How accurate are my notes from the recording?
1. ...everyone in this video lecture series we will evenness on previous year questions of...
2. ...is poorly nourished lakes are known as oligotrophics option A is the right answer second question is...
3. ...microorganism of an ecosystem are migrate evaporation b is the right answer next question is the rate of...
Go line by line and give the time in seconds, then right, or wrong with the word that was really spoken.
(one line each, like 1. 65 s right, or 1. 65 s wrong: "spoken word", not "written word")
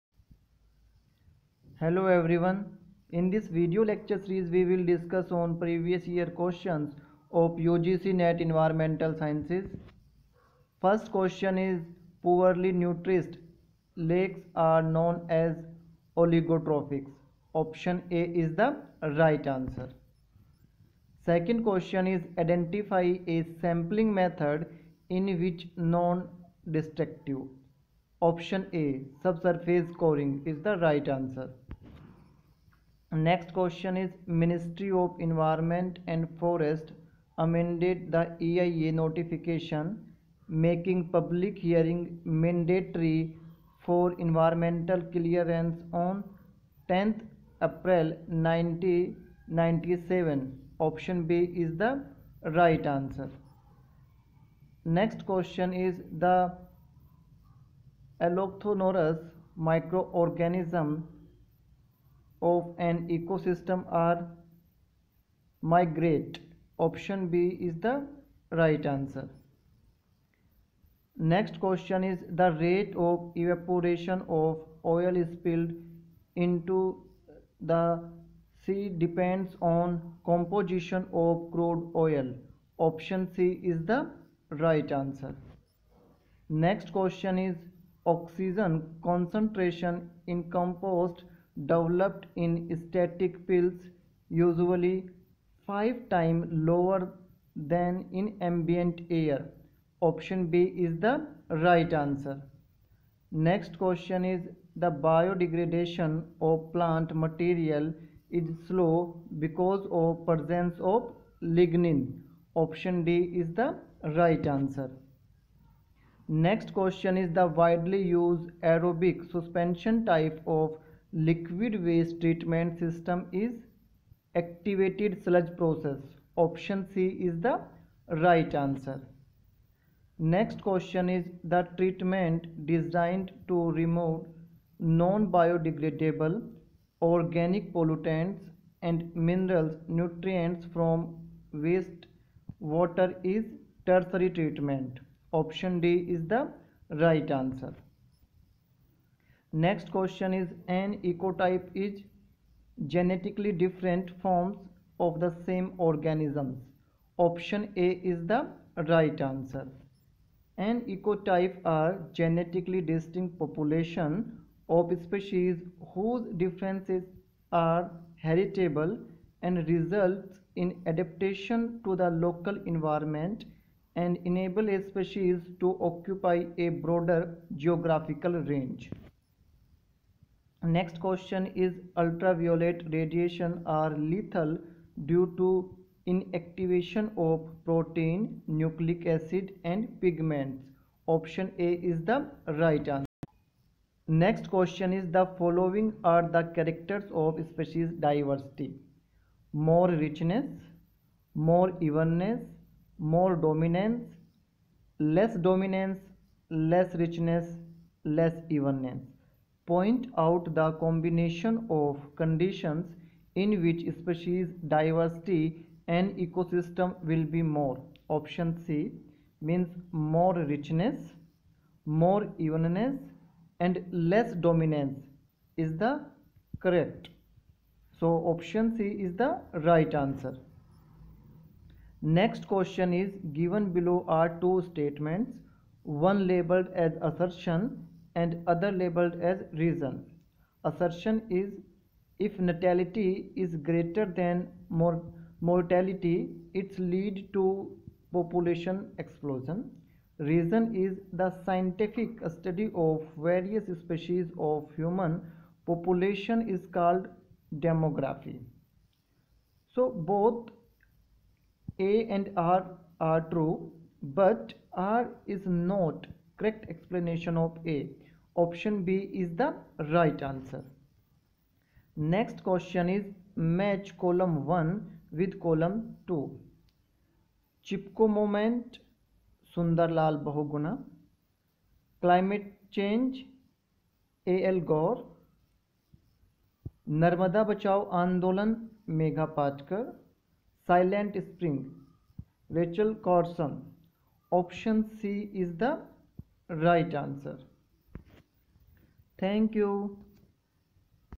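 1. 2 s wrong: "discuss", not "evenness"
2. 11 s right
3. 59 s wrong: "option", not "evaporation".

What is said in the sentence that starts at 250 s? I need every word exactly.
Reason is the scientific study of various species of human population is called demography.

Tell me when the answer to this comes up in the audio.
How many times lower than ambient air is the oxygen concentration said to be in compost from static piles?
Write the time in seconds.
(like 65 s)
95 s.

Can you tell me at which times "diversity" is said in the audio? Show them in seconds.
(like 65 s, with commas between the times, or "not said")
197 s, 214 s.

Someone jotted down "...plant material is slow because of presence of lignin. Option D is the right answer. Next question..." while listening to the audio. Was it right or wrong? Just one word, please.
right.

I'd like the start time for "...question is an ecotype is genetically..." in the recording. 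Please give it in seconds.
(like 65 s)
149 s.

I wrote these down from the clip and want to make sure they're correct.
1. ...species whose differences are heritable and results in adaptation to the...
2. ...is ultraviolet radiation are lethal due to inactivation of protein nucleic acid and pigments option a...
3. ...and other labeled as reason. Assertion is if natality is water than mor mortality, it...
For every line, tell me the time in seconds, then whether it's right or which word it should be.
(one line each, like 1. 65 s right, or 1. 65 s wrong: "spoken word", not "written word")
1. 165 s right
2. 181 s right
3. 238 s wrong: "greater", not "water".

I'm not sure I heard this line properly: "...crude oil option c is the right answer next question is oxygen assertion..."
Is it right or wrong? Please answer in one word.
wrong.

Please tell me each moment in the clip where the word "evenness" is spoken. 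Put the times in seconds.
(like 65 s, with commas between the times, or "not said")
201 s, 208 s, 222 s.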